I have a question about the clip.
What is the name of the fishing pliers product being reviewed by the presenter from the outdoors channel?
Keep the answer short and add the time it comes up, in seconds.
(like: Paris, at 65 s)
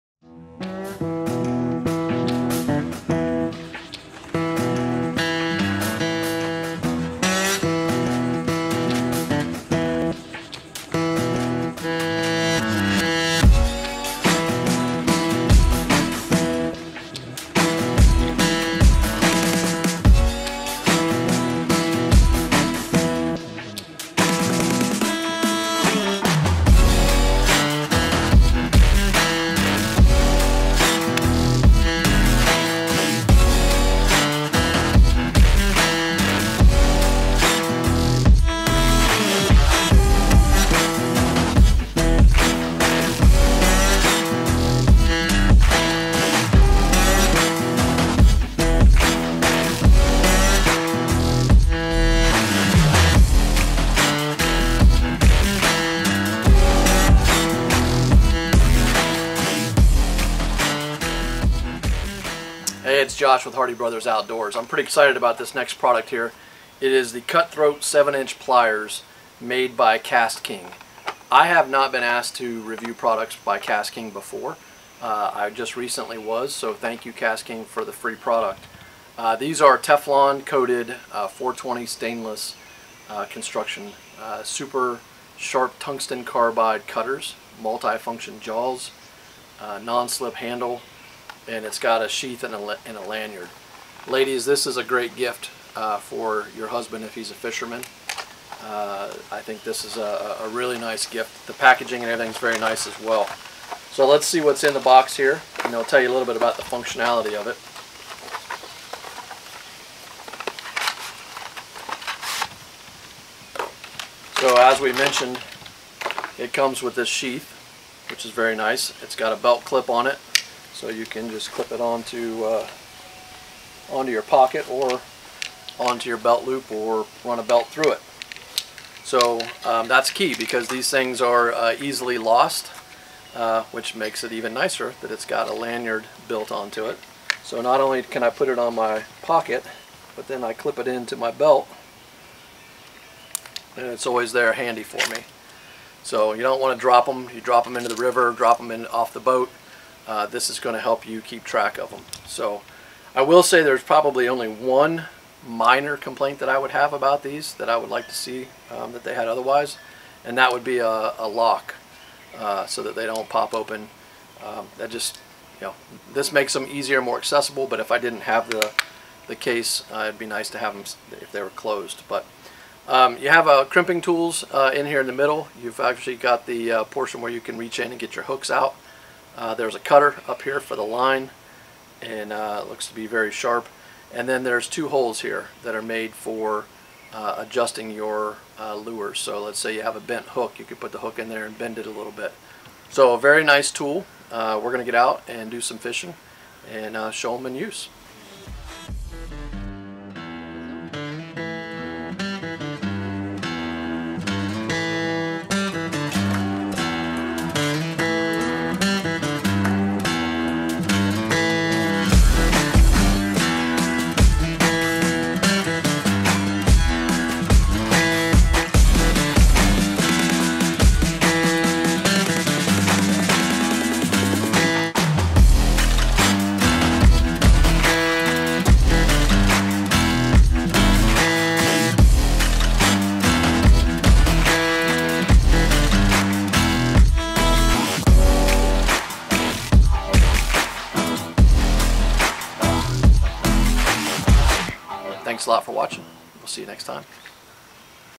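Cutthroat, at 67 s.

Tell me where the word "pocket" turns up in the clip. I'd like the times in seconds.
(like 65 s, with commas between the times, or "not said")
124 s, 139 s.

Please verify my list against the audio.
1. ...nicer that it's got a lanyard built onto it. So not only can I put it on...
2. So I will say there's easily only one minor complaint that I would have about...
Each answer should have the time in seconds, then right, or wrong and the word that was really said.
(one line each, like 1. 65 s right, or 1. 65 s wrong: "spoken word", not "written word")
1. 134 s right
2. 152 s wrong: "probably", not "easily".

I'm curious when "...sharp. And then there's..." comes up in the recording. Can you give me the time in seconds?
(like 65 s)
183 s.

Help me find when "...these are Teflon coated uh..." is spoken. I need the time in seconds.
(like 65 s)
79 s.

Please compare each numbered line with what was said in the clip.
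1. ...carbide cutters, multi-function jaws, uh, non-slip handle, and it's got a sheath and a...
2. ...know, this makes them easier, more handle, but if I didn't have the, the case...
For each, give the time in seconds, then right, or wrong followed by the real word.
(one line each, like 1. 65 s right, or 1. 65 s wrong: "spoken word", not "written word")
1. 86 s right
2. 165 s wrong: "accessible", not "handle".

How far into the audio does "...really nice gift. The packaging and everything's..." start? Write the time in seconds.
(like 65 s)
100 s.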